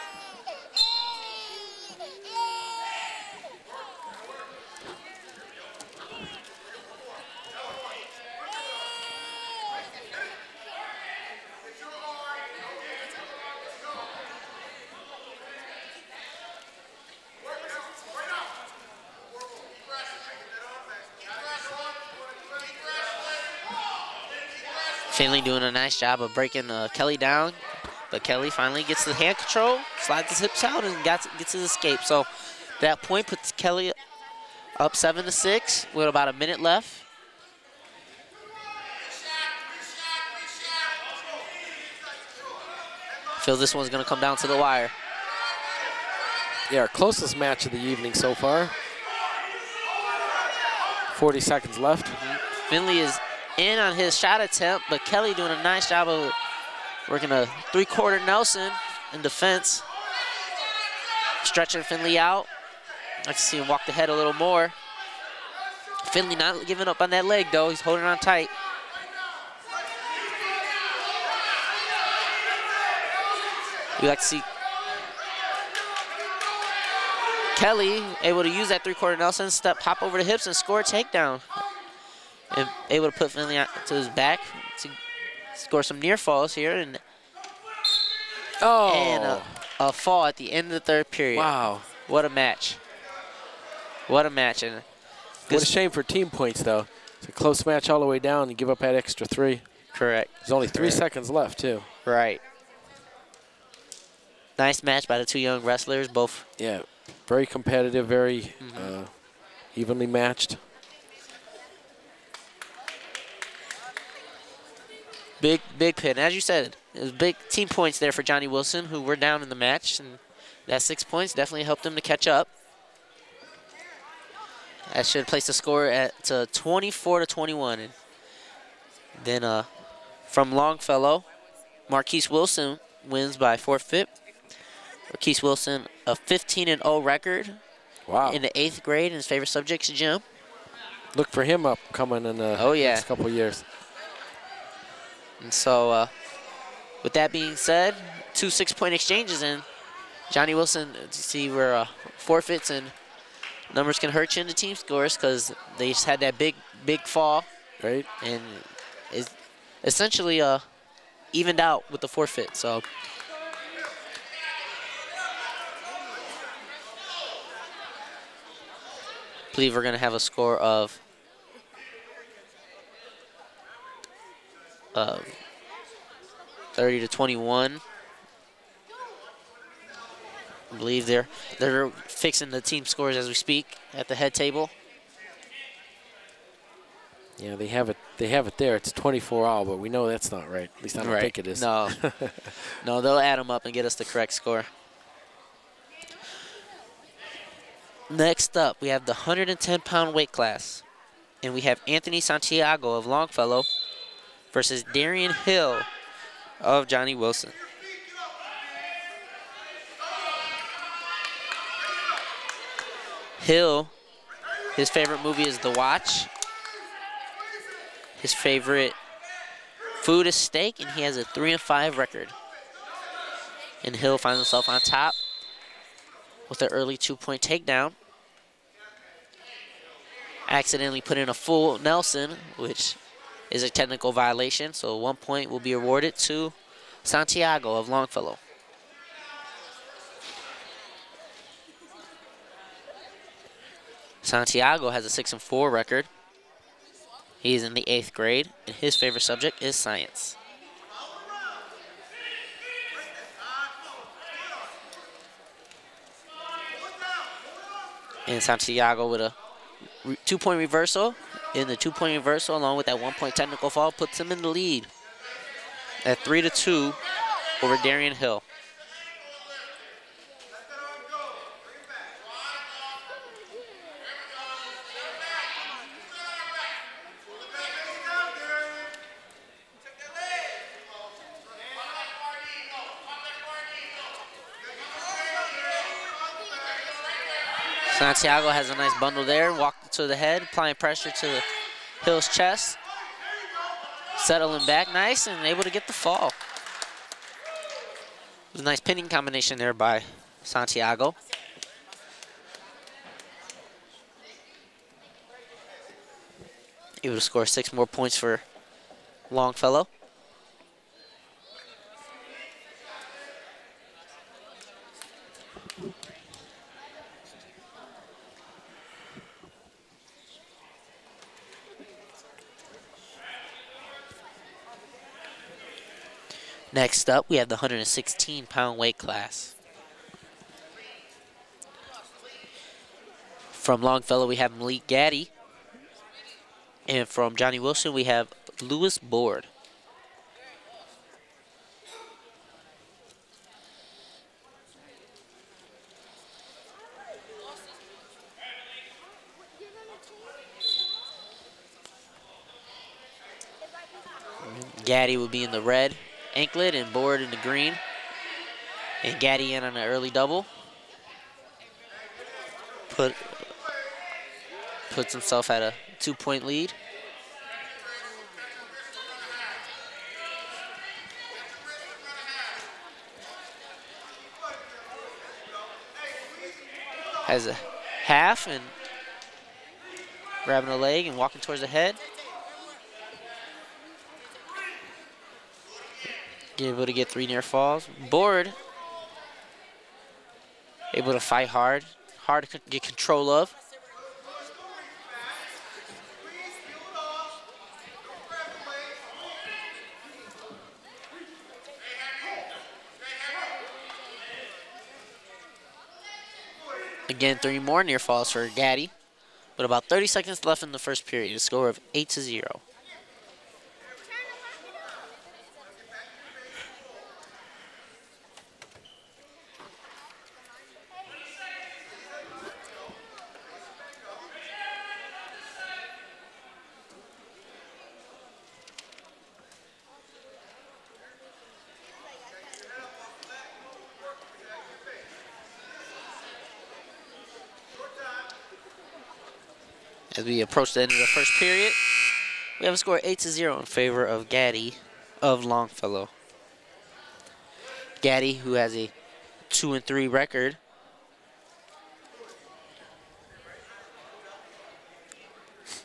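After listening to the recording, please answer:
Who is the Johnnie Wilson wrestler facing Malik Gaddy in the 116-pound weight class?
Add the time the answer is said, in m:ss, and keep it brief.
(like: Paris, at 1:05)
Lewis Board, at 5:38.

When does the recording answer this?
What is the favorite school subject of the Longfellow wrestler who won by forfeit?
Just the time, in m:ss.
2:19.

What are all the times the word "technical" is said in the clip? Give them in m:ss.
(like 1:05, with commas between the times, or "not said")
3:53, 4:23.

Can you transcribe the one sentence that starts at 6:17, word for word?
Has a half and grabbing a leg and walking towards the head.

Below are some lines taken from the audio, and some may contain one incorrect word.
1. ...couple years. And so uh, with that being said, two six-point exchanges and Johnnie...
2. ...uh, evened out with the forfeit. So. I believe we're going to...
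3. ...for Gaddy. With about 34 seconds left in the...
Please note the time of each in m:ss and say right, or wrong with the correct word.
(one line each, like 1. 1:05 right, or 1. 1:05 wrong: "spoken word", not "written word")
1. 2:23 right
2. 2:40 right
3. 6:48 wrong: "30", not "34".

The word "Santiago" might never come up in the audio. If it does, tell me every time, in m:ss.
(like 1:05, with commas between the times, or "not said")
3:22, 3:57, 4:04, 4:18, 4:48, 5:00.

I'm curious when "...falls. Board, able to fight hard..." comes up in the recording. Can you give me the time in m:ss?
6:27.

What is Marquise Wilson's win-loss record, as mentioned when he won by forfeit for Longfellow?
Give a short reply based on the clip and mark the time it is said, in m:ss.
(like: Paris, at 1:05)
15 and 0, at 2:16.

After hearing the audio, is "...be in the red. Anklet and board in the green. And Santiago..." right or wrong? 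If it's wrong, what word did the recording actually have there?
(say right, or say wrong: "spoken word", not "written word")
wrong: "Gaddy", not "Santiago".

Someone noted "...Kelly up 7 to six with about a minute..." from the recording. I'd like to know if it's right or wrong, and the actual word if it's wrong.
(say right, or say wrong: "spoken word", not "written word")
right.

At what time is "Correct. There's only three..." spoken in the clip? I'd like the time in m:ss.
1:39.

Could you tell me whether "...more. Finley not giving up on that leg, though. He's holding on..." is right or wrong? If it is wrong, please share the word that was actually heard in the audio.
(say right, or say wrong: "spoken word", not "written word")
right.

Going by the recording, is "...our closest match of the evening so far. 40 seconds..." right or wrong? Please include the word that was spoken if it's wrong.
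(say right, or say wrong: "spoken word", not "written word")
right.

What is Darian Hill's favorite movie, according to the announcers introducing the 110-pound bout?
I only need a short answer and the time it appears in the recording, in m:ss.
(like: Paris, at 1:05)
The Watch, at 3:35.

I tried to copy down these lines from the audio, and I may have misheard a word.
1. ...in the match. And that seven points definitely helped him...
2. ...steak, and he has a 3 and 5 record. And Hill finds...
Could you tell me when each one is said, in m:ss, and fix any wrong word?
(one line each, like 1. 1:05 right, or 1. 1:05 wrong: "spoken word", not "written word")
1. 1:59 wrong: "six", not "seven"
2. 3:40 right.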